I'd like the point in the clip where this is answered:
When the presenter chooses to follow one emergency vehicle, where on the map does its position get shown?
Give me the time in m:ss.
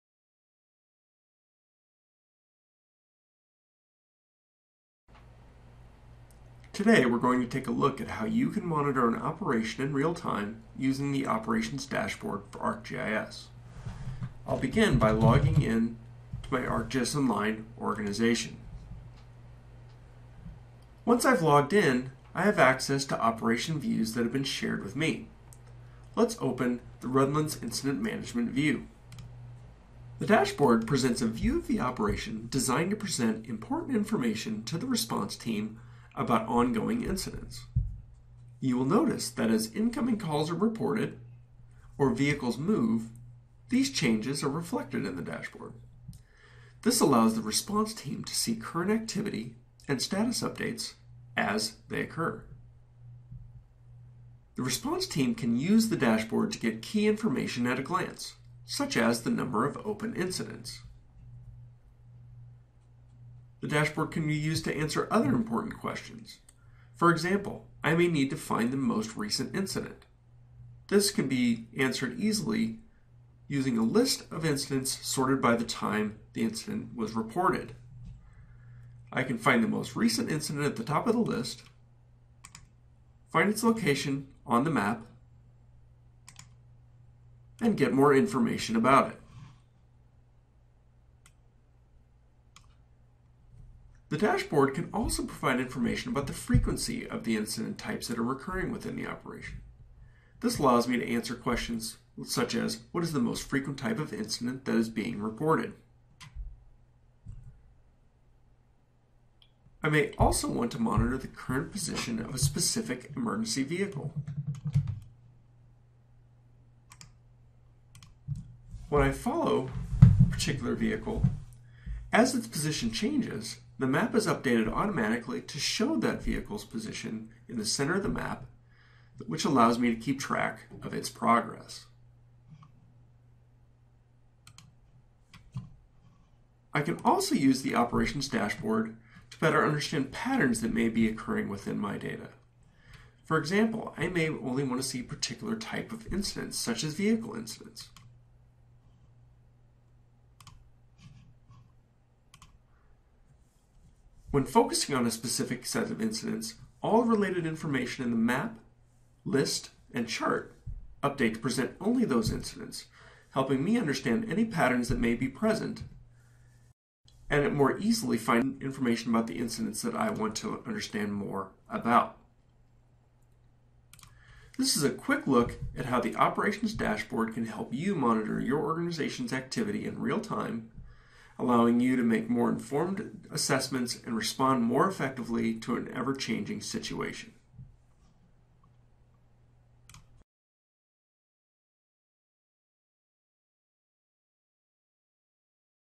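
2:07.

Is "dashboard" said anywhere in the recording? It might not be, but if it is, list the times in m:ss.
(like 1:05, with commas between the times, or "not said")
0:11, 0:30, 0:45, 0:55, 1:03, 1:34, 2:18, 2:56.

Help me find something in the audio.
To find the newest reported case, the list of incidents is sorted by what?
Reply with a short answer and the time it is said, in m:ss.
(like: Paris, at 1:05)
time the incident was reported, at 1:15.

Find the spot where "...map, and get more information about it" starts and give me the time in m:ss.
1:24.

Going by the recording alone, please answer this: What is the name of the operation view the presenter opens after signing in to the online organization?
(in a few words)
Redlands Incident Management.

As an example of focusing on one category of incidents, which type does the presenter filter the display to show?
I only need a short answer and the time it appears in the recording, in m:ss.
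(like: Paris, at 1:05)
vehicle incidents, at 2:26.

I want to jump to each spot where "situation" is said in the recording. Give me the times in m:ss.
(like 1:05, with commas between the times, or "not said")
3:06.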